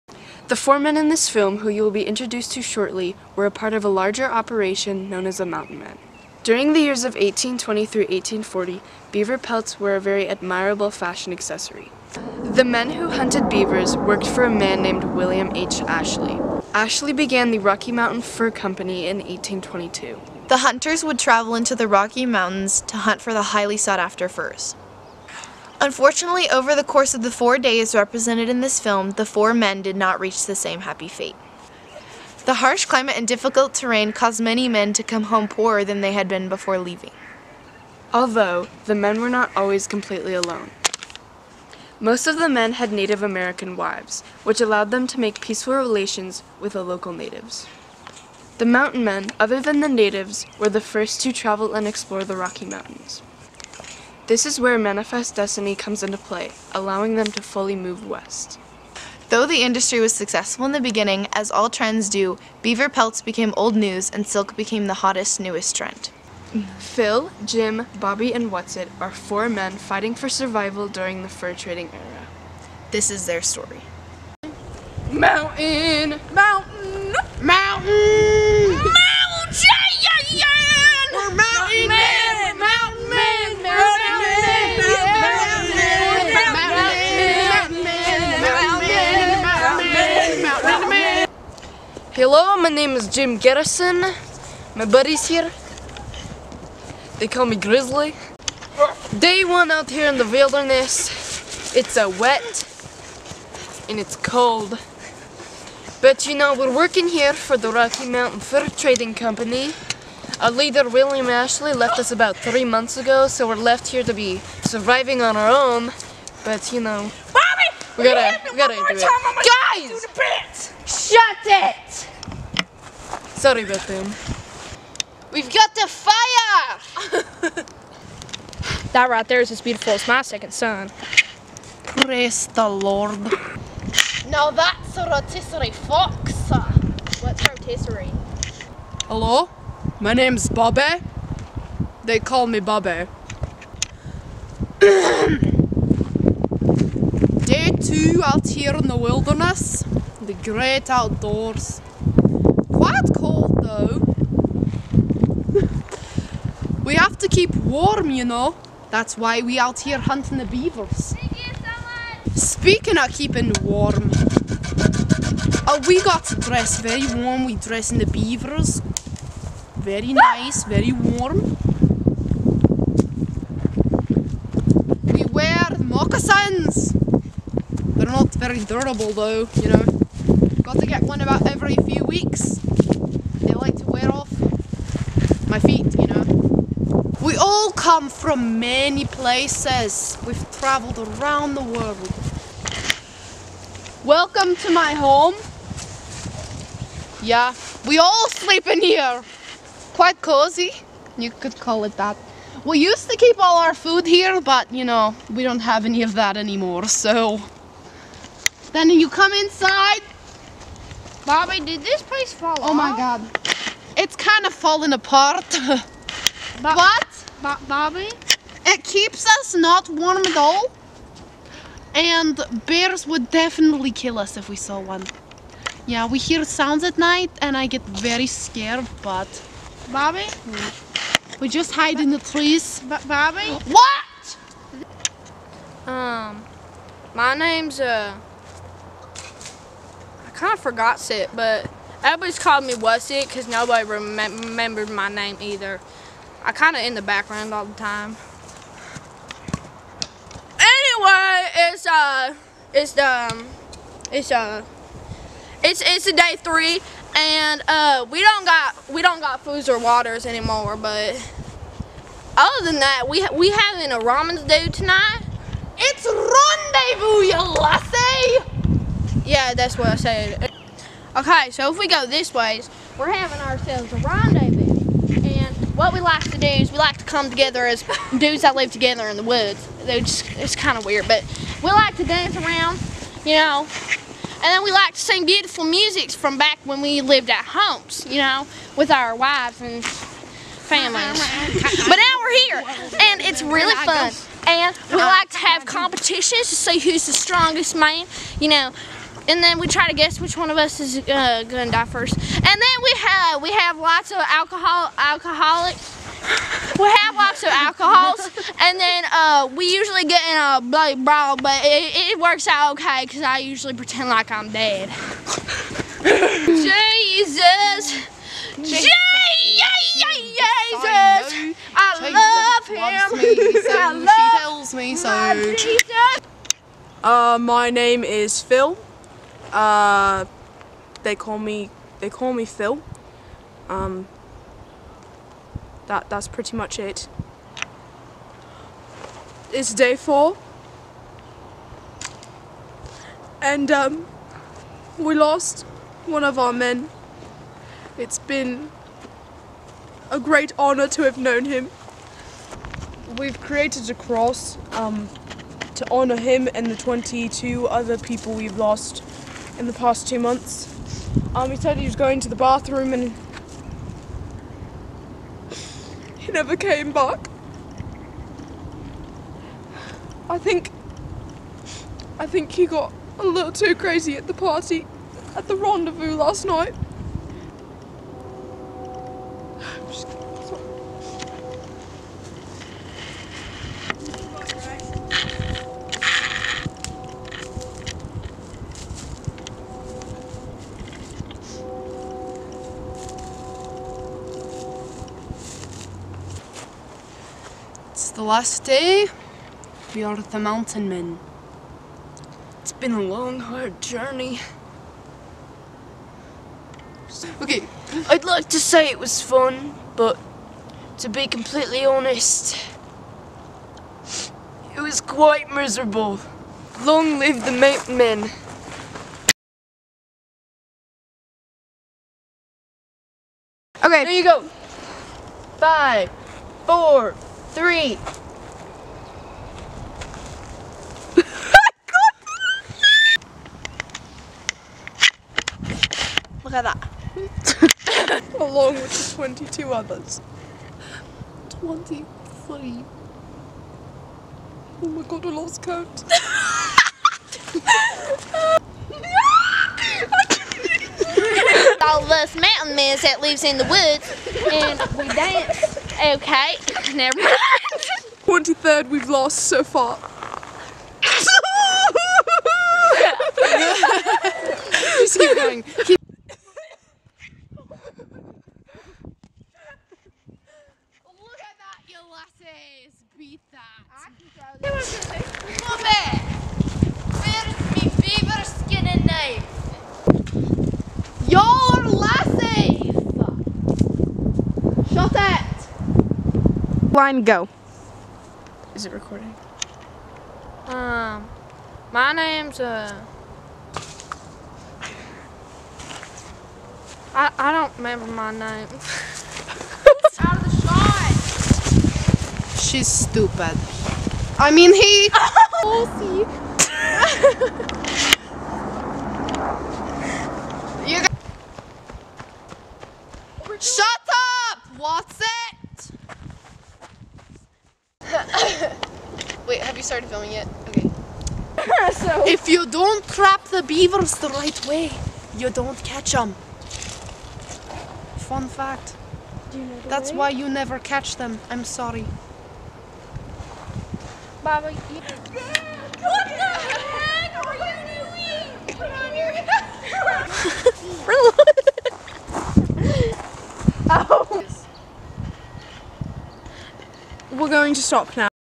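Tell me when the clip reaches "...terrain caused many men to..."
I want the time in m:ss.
0:33.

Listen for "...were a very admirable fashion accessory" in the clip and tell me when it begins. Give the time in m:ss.
0:09.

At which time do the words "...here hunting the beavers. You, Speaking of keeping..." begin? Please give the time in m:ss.
2:39.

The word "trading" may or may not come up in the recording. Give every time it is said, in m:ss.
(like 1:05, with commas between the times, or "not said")
1:11, 1:48.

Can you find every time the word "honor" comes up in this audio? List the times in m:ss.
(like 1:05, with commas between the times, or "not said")
5:50, 5:55.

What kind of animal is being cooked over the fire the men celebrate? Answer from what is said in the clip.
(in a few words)
Fox.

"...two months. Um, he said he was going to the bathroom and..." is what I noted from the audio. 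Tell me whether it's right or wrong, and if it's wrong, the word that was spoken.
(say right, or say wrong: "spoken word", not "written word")
right.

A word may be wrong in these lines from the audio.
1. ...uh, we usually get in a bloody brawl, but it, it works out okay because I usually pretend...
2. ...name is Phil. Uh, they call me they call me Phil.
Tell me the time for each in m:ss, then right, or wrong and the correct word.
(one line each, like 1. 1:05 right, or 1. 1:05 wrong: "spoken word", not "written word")
1. 5:09 right
2. 5:27 right.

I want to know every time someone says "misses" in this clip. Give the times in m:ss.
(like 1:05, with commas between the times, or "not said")
not said.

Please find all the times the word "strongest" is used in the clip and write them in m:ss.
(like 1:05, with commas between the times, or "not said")
4:57.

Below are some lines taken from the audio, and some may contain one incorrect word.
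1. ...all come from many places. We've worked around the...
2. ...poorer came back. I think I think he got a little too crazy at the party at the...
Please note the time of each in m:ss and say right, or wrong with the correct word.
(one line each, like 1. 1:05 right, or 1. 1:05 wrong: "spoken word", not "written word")
1. 3:07 wrong: "traveled", not "worked"
2. 6:06 wrong: "never", not "poorer".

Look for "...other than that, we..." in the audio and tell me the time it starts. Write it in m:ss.
4:22.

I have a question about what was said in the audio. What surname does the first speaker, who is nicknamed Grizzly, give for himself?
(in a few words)
Garrison.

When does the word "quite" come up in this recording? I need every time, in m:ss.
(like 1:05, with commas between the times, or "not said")
2:32, 3:19, 6:54.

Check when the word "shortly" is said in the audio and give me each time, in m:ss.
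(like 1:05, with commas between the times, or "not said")
0:02.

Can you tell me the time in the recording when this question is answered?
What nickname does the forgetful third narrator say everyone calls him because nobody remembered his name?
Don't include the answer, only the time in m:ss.
4:02.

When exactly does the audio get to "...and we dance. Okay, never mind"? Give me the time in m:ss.
7:34.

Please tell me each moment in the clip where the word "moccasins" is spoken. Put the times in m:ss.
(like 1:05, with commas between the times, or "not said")
2:55.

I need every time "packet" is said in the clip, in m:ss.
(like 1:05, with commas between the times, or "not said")
not said.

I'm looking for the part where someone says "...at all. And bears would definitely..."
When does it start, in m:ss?
3:40.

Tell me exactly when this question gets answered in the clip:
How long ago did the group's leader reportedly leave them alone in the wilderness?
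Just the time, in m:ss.
1:52.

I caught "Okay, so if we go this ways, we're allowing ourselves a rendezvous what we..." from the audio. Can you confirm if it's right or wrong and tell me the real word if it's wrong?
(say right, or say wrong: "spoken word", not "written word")
wrong: "having", not "allowing".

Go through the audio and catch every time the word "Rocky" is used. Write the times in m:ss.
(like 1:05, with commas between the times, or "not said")
0:17, 0:21, 0:52, 1:47.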